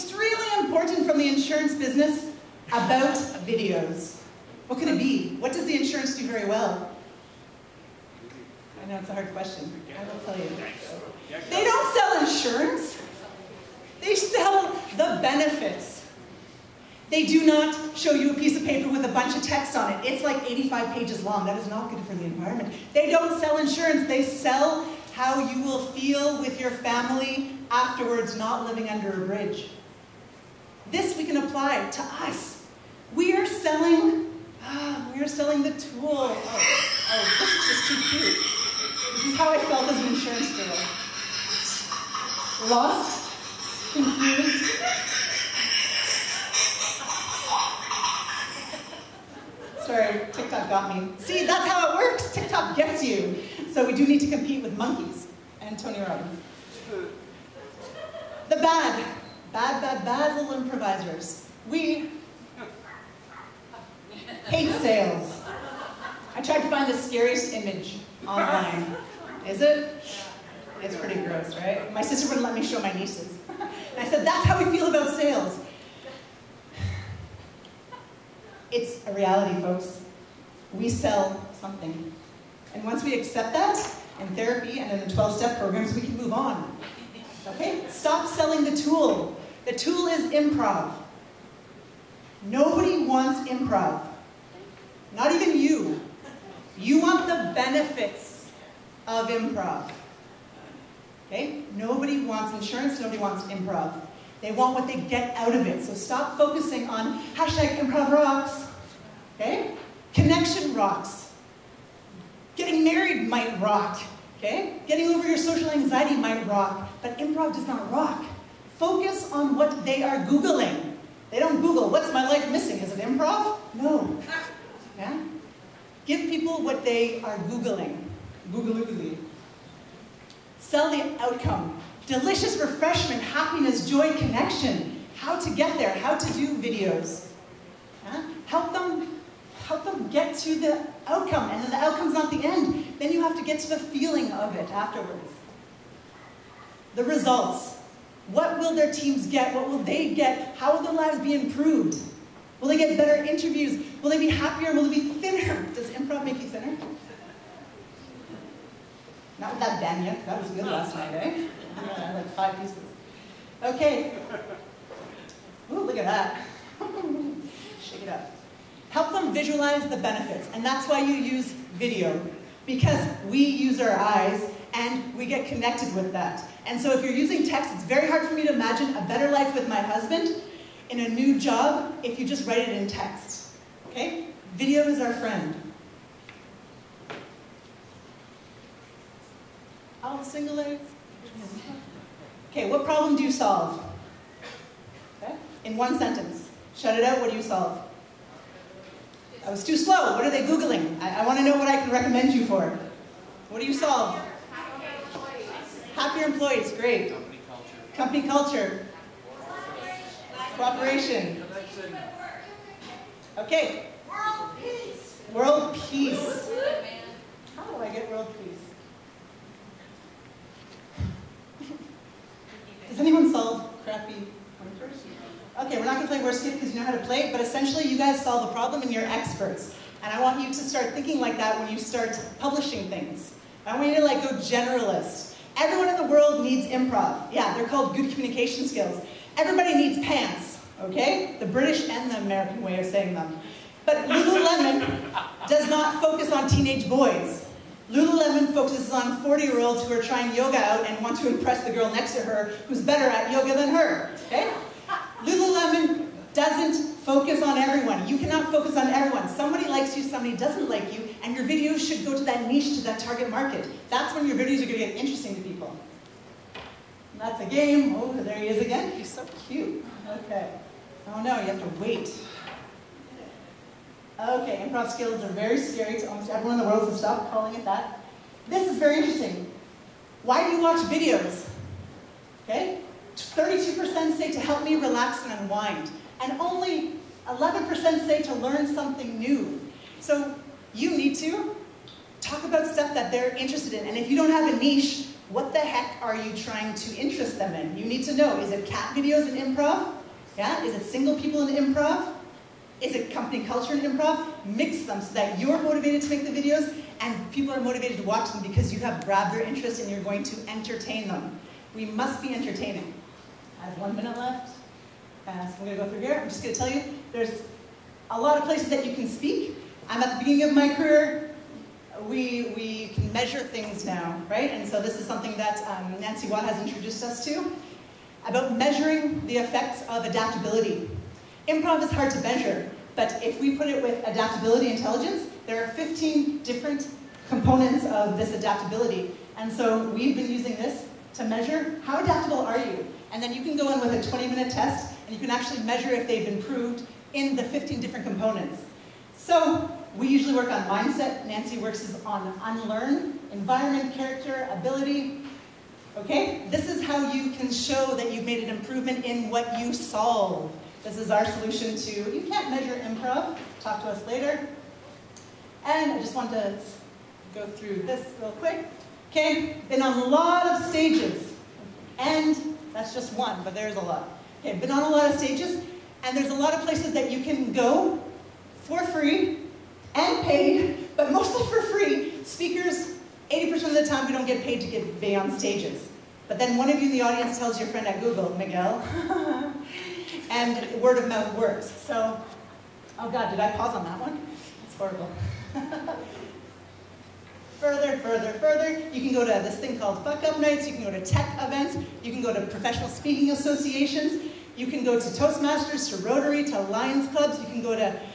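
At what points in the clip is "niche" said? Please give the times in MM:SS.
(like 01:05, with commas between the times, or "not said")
04:22, 04:54.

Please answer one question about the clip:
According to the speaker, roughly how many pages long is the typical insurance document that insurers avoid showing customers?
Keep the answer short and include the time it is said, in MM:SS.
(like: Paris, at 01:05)
85, at 00:20.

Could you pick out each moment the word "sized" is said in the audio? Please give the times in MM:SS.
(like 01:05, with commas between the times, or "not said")
not said.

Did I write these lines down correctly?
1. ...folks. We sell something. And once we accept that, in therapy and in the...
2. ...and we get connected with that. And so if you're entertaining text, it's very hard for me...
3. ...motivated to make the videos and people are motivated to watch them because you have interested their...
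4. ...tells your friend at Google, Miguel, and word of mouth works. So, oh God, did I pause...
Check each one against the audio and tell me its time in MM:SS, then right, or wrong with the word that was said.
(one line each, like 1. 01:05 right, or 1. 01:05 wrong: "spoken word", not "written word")
1. 01:19 right
2. 02:54 wrong: "using", not "entertaining"
3. 05:05 wrong: "grabbed", not "interested"
4. 06:27 right.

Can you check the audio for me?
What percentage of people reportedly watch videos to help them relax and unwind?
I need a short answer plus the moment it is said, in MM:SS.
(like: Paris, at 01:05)
32%, at 04:43.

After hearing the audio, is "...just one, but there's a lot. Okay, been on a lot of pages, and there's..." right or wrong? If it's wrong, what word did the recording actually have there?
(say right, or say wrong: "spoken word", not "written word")
wrong: "stages", not "pages".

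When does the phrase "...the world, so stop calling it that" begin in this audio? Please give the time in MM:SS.
04:36.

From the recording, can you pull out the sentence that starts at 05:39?
And so we've been using this to measure how adaptable are you?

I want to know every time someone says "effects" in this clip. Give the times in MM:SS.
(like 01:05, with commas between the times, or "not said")
05:29.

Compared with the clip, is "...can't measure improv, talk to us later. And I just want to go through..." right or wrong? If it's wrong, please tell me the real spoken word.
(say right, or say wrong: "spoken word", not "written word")
right.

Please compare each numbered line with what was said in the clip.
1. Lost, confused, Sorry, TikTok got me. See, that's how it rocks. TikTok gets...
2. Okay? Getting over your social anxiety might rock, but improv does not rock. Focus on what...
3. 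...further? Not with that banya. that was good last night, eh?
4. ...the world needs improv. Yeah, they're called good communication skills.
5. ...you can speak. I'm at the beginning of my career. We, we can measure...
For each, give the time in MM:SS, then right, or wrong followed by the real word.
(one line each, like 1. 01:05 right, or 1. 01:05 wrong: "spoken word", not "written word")
1. 00:42 wrong: "works", not "rocks"
2. 01:54 right
3. 02:36 wrong: "thinner", not "further"
4. 03:55 right
5. 05:18 right.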